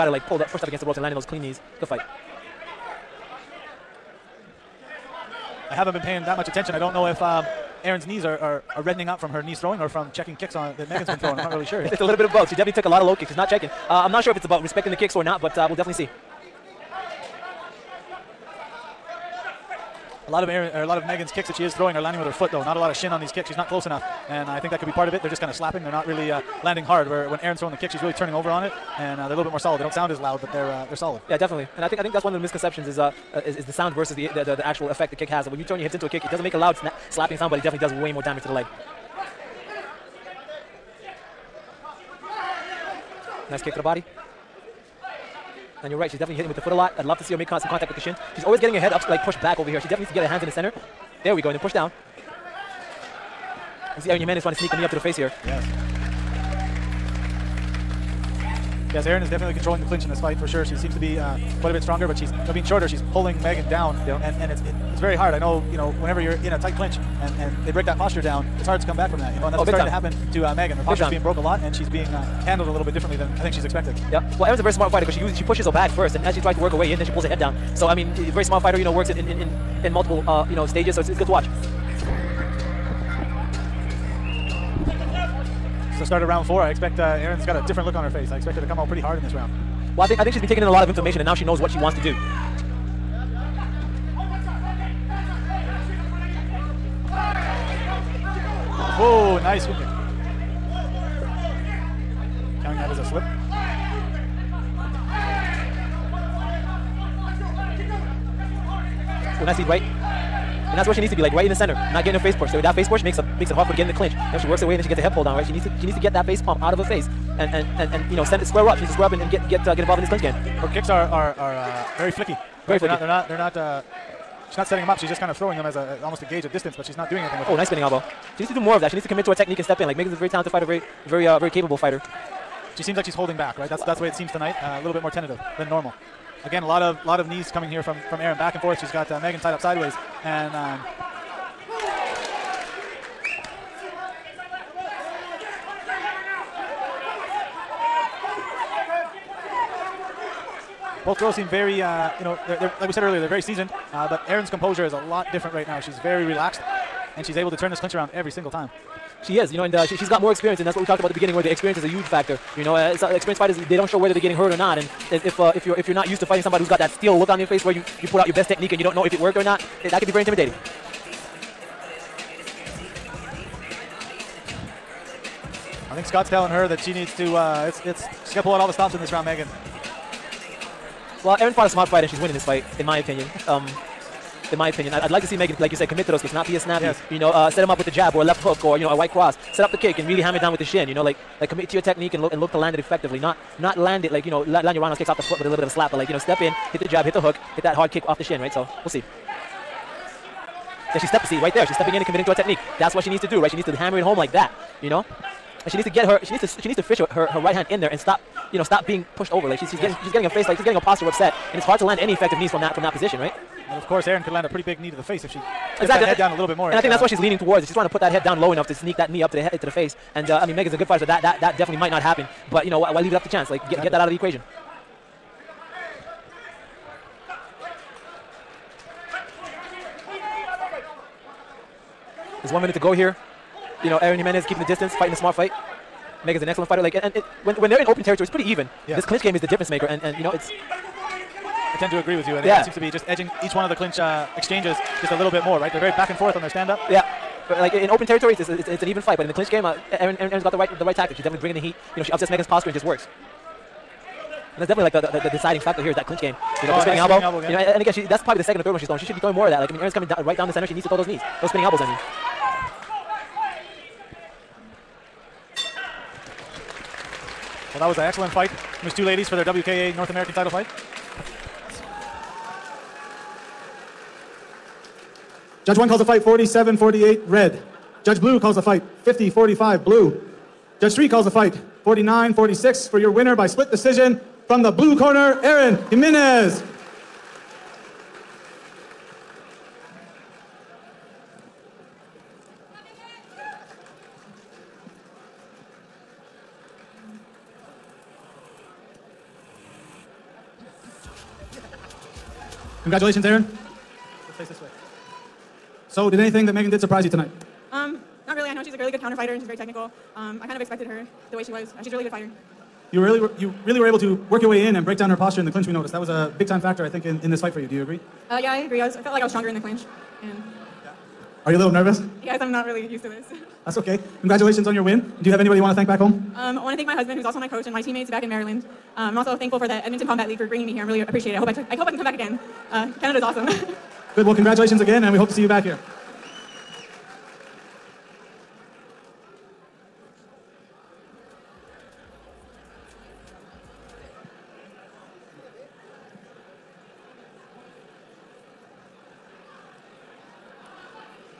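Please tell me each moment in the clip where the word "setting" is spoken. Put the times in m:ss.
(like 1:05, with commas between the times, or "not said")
2:04.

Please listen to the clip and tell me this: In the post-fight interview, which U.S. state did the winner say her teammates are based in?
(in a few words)
Maryland.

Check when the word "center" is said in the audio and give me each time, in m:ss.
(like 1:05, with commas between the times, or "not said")
0:50, 1:51, 4:20.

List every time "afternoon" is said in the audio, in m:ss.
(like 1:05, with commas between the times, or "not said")
not said.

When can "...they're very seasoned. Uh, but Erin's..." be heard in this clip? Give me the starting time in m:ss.
2:33.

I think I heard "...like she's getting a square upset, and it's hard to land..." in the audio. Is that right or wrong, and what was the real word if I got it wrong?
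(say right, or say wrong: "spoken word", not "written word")
wrong: "posture", not "square".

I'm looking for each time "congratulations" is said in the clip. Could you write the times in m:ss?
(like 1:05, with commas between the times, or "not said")
5:02, 5:24, 5:34.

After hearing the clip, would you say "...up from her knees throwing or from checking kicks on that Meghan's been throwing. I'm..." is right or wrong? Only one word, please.
right.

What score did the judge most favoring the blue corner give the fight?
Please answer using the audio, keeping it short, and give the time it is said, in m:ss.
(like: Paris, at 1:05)
50-45, at 4:39.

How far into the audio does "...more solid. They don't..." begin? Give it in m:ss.
0:29.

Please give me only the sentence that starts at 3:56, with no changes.
Like, and, and it, when when they're in open territory, it's pretty even.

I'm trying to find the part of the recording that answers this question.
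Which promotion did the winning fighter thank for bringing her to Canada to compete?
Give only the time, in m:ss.
5:29.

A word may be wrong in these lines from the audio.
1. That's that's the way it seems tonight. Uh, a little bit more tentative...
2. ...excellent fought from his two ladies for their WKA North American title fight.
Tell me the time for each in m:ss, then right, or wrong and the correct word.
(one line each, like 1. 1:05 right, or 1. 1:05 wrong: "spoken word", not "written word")
1. 2:13 right
2. 4:28 wrong: "fight", not "fought".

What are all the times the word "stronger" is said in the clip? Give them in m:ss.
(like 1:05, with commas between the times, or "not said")
1:01, 5:19.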